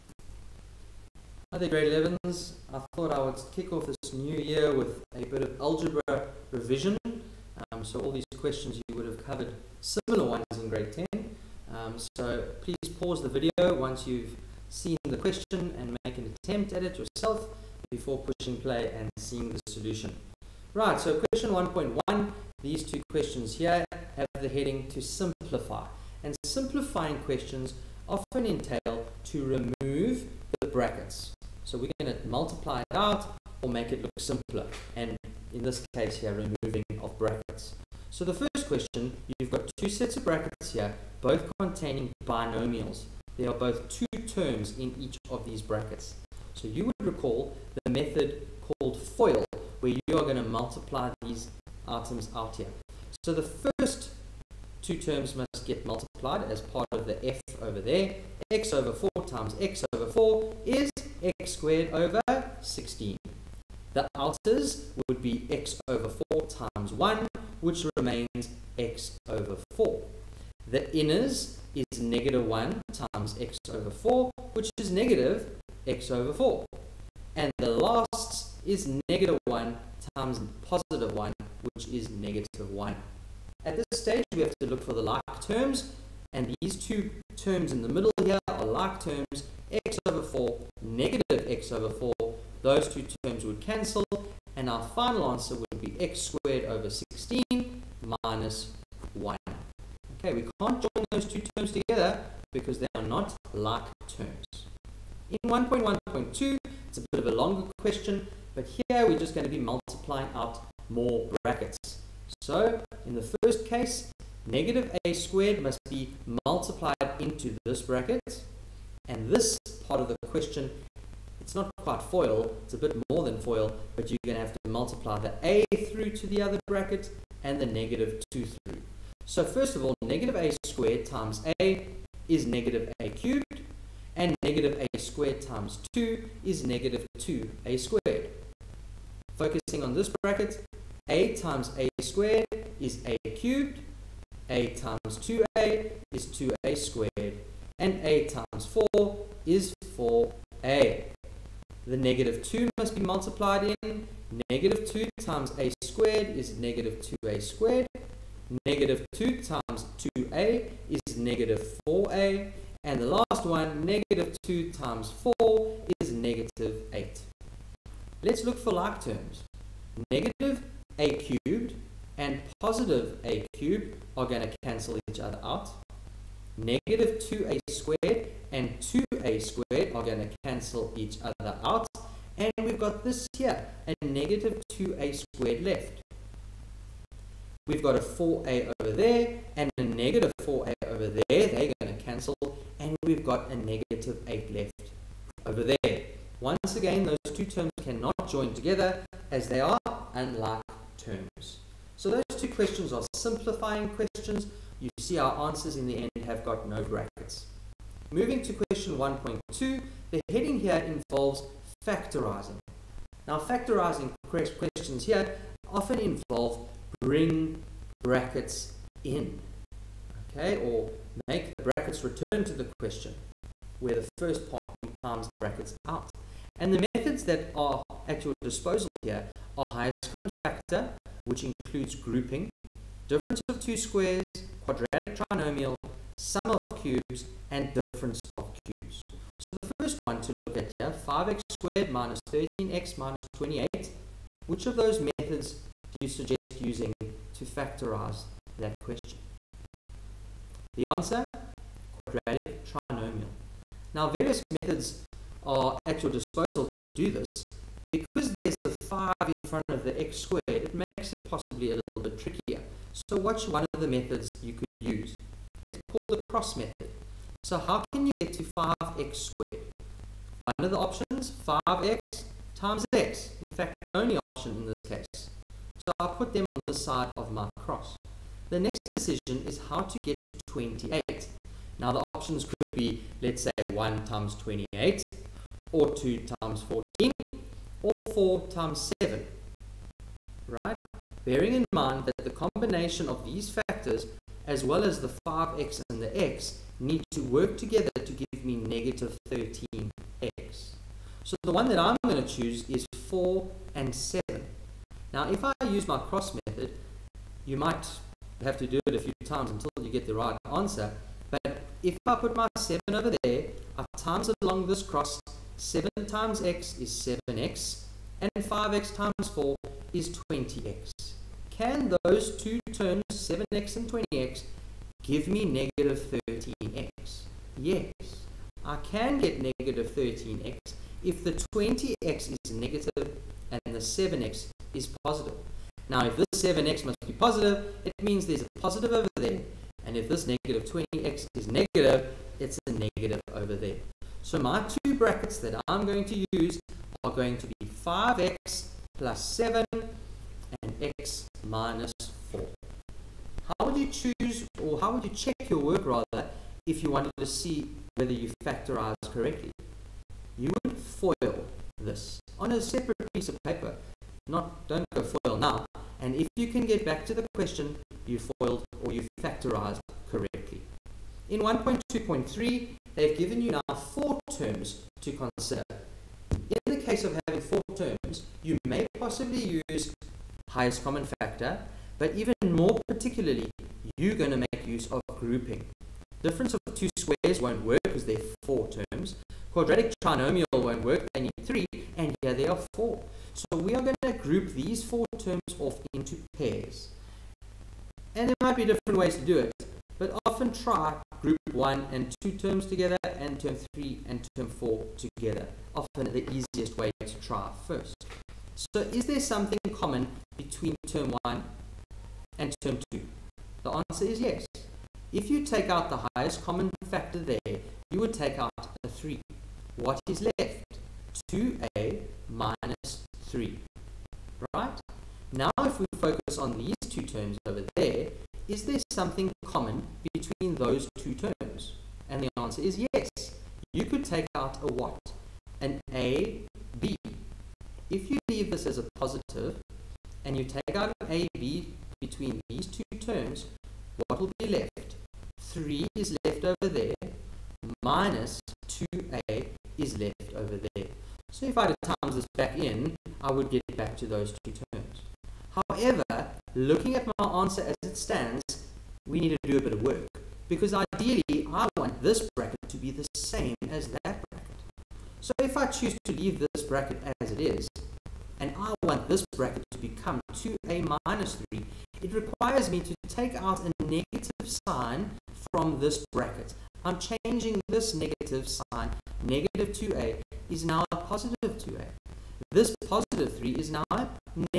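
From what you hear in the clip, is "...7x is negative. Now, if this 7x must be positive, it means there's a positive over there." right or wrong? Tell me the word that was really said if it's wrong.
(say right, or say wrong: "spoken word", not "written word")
wrong: "positive", not "negative".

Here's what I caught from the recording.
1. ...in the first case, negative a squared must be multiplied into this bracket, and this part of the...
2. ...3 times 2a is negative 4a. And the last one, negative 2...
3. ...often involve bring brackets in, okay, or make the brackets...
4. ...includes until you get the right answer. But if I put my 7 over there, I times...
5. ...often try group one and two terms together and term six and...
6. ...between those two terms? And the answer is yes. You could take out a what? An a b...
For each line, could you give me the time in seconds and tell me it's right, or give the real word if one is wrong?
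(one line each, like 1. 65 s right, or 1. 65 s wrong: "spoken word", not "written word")
1. 113 s right
2. 159 s wrong: "2", not "3"
3. 215 s right
4. 309 s wrong: "times", not "includes"
5. 400 s wrong: "three", not "six"
6. 430 s right.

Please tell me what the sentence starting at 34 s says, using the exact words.
And in this case here, removing of brackets.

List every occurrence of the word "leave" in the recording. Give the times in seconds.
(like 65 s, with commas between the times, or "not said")
438 s, 466 s.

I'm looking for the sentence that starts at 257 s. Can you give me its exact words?
Because there's a 5 in front of the x squared, it makes it possibly a little bit trickier.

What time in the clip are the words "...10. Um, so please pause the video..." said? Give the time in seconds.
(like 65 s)
10 s.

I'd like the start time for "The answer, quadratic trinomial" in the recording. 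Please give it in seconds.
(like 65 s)
250 s.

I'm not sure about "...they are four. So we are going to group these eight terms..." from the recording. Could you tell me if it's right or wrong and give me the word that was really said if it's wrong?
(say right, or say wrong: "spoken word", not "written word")
wrong: "four", not "eight".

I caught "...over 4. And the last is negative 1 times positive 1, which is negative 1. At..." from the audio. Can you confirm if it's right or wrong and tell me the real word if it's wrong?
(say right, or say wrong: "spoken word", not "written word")
right.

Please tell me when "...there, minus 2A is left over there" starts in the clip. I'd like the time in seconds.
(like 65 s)
446 s.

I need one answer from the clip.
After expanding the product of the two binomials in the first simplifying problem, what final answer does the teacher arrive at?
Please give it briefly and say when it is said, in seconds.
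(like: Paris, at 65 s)
x squared over 16 minus 1, at 96 s.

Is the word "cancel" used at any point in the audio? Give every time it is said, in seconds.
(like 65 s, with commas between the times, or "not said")
93 s, 174 s, 180 s, 192 s.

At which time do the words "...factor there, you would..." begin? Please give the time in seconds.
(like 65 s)
416 s.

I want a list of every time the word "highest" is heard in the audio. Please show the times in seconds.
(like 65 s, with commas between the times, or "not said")
229 s, 380 s, 416 s.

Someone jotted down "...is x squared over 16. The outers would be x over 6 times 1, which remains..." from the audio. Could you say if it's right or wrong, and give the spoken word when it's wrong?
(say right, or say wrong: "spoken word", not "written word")
wrong: "4", not "6".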